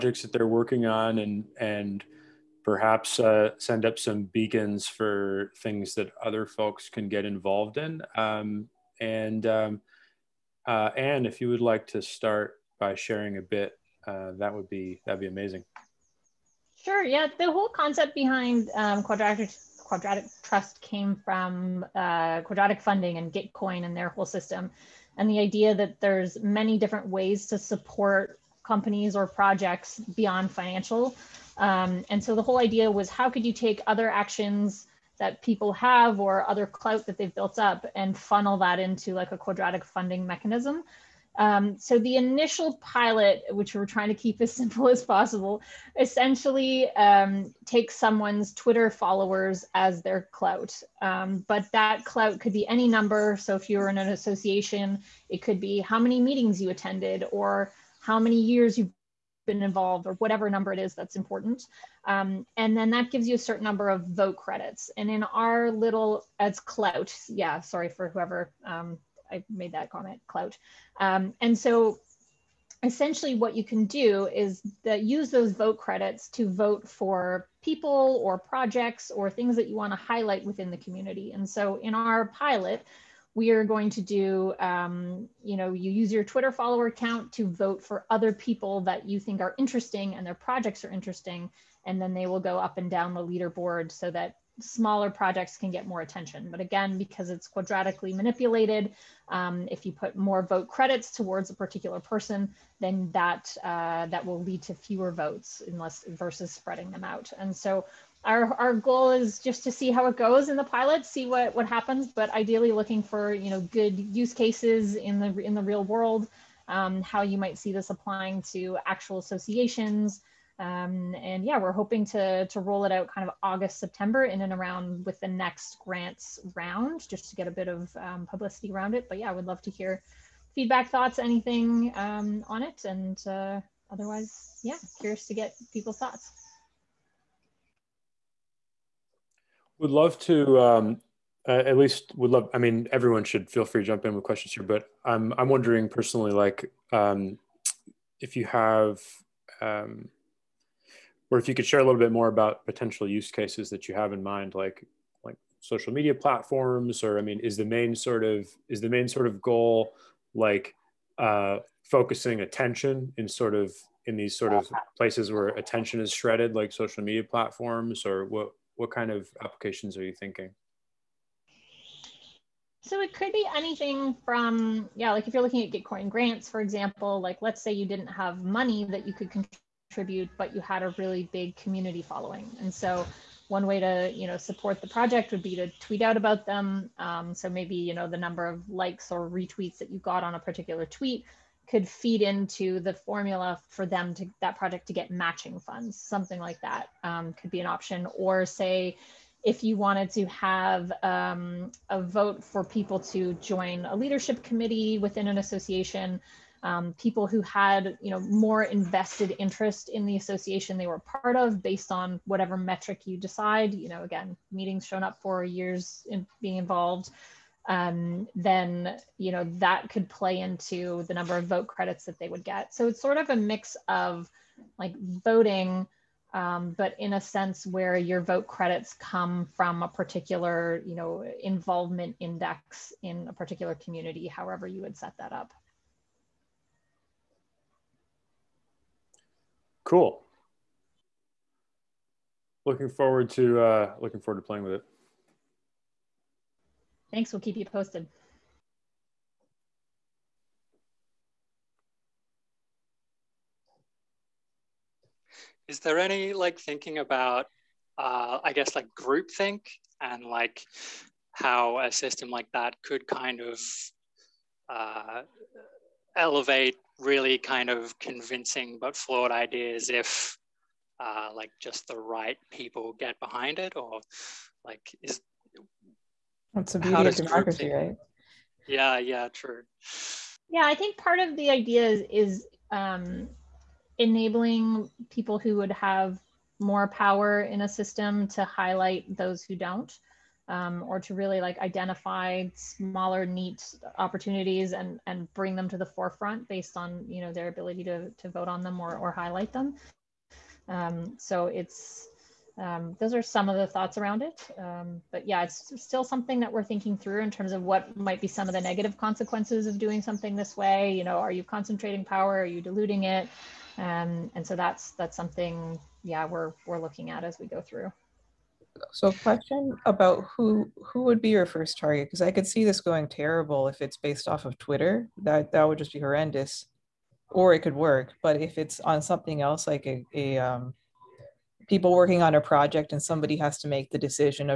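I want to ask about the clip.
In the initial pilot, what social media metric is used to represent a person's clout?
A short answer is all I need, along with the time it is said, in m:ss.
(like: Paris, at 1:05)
Twitter followers, at 0:48.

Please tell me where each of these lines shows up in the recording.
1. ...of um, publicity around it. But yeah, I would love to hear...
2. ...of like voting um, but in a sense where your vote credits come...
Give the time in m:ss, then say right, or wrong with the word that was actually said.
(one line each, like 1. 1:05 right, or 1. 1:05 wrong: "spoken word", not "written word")
1. 2:07 right
2. 3:43 right.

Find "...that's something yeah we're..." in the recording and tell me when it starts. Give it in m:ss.
5:14.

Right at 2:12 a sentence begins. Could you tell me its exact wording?
And uh, otherwise, yeah, curious to get people's thoughts.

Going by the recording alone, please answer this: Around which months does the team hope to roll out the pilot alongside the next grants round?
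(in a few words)
August, September.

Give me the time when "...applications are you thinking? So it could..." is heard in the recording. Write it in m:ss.
2:49.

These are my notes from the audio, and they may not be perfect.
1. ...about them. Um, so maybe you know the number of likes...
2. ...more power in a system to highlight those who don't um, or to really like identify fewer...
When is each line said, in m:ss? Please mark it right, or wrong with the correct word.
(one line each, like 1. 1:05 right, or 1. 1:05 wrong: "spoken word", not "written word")
1. 3:06 right
2. 4:46 wrong: "smaller", not "fewer".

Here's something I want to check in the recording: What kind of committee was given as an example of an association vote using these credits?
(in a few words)
leadership committee.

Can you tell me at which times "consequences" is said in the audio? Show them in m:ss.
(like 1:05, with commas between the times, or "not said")
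5:08.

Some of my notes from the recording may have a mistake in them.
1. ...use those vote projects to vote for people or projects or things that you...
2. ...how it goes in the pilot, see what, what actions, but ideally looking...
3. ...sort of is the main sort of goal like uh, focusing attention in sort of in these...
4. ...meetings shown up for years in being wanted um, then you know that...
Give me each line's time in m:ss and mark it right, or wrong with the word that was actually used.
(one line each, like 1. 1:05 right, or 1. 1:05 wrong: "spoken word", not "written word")
1. 1:15 wrong: "credits", not "projects"
2. 1:49 wrong: "happens", not "actions"
3. 2:37 right
4. 3:34 wrong: "involved", not "wanted".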